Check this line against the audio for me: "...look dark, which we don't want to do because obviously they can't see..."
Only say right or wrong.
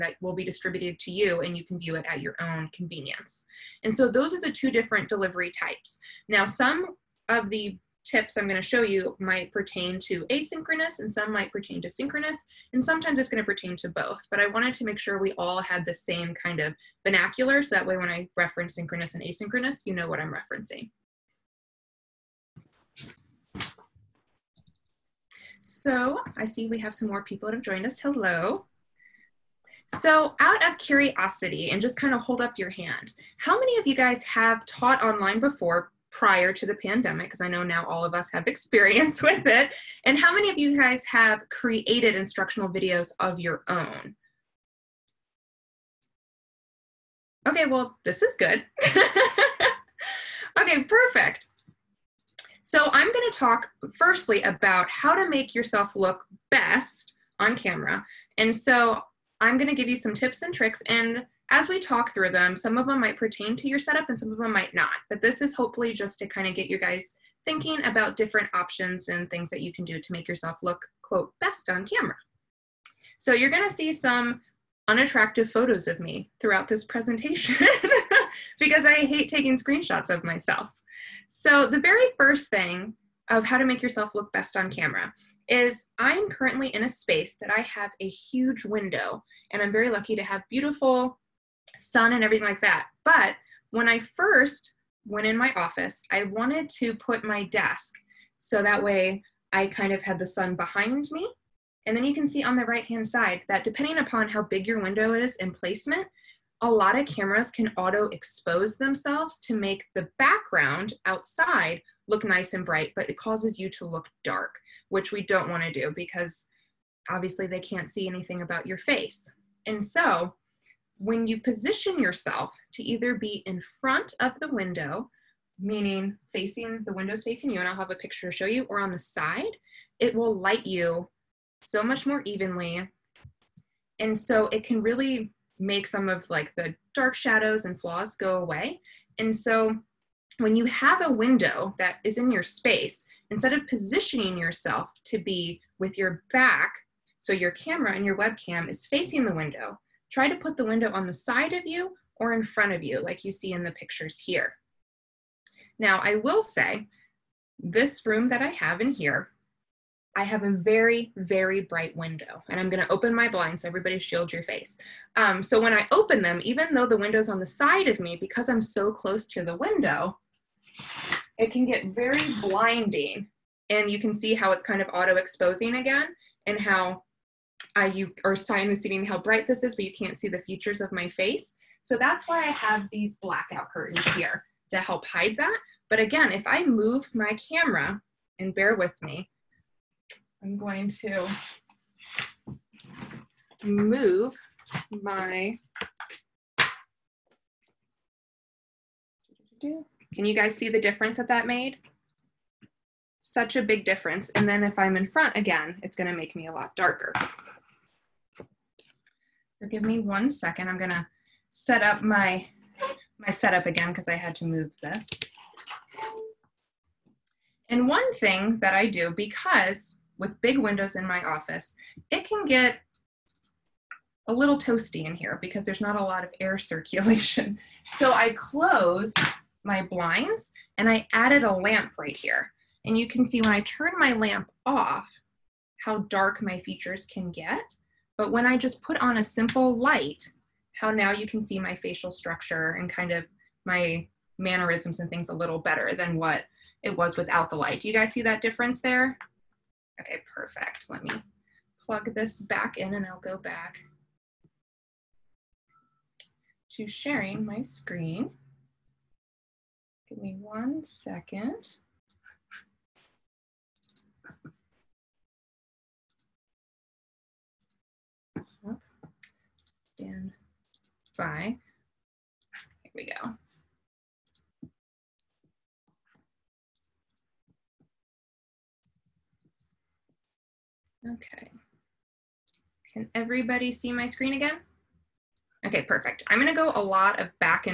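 right.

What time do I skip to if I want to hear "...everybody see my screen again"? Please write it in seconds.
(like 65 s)
283 s.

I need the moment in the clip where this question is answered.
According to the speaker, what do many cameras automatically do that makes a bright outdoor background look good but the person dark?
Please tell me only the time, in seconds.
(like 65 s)
107 s.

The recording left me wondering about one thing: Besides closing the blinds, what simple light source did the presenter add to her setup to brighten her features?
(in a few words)
A lamp.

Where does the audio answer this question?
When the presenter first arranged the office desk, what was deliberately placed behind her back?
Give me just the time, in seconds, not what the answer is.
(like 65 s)
100 s.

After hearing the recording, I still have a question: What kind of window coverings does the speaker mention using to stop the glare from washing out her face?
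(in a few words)
Blackout curtains.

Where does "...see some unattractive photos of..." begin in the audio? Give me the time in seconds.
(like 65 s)
73 s.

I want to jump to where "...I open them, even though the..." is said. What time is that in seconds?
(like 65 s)
165 s.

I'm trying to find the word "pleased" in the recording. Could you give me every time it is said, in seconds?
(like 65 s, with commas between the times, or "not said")
not said.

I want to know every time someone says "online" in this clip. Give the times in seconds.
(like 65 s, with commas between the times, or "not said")
35 s.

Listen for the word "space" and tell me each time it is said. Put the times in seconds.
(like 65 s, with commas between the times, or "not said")
86 s, 142 s.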